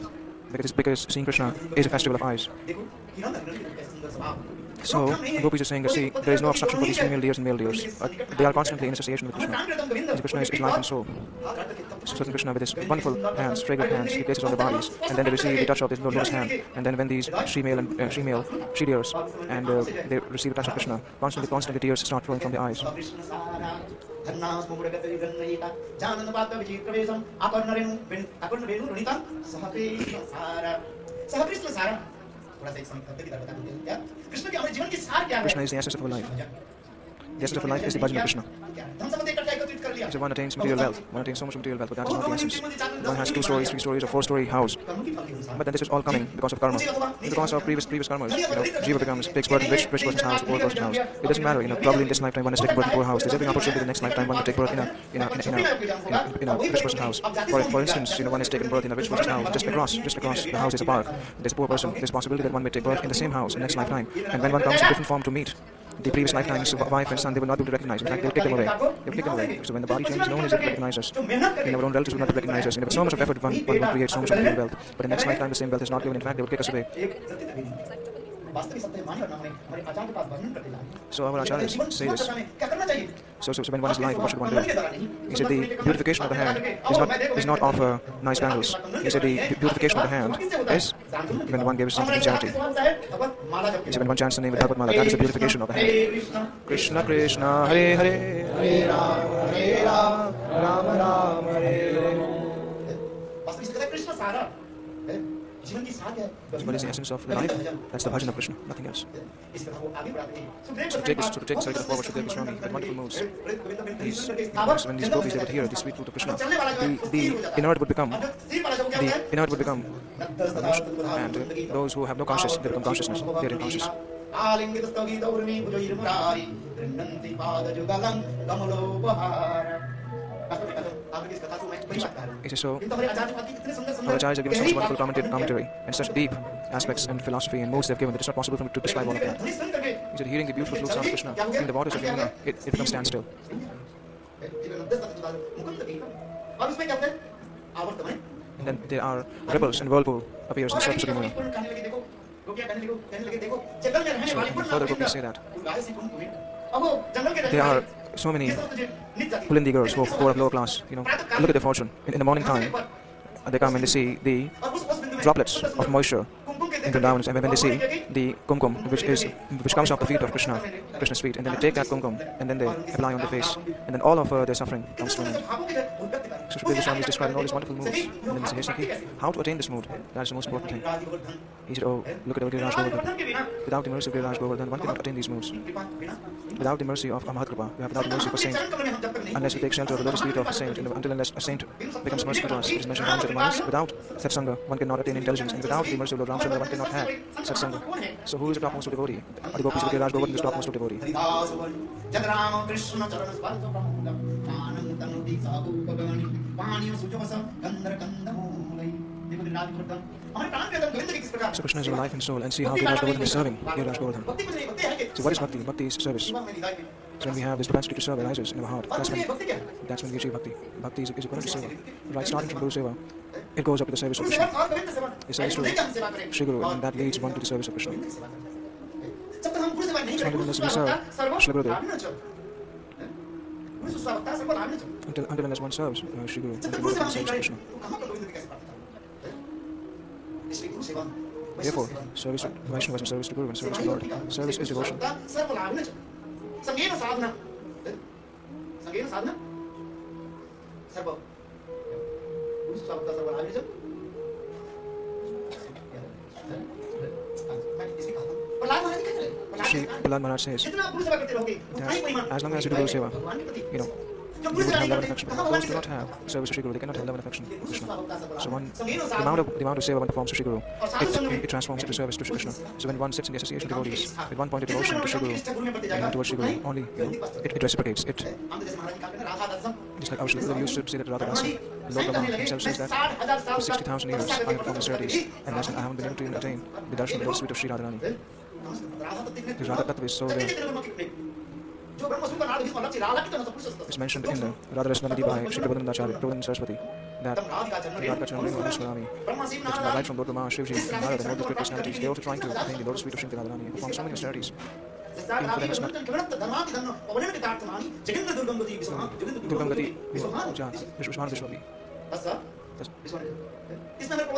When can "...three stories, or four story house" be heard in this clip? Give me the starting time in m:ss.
0:43.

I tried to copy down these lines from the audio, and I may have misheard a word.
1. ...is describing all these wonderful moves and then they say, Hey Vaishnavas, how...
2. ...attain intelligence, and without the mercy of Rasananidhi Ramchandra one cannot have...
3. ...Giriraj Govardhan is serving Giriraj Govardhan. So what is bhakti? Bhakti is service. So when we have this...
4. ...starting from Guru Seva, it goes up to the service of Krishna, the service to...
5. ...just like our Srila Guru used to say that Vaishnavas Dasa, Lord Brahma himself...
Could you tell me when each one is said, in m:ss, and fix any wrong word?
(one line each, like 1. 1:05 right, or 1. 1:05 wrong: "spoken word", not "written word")
1. 2:56 wrong: "Sakhi", not "Vaishnavas"
2. 3:14 wrong: "Lord", not "Rasananidhi"
3. 3:32 right
4. 3:42 right
5. 4:39 wrong: "Radha", not "Vaishnavas".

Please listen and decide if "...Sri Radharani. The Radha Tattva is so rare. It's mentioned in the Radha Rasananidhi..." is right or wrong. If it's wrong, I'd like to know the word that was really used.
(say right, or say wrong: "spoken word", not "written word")
right.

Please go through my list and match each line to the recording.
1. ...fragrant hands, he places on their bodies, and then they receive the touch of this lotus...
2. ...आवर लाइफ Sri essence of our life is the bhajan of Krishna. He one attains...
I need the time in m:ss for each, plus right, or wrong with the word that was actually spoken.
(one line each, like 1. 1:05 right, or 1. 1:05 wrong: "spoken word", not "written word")
1. 0:13 right
2. 0:36 wrong: "The", not "Sri".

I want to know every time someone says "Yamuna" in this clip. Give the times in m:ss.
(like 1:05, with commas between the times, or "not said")
2:21, 2:31.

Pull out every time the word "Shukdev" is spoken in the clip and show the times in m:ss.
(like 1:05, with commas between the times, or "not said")
1:52, 2:56.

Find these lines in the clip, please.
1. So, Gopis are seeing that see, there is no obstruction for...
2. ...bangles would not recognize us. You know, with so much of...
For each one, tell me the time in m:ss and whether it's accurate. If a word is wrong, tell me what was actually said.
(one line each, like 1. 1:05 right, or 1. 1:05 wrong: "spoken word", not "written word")
1. 0:04 wrong: "saying", not "seeing"
2. 1:11 wrong: "relatives", not "bangles".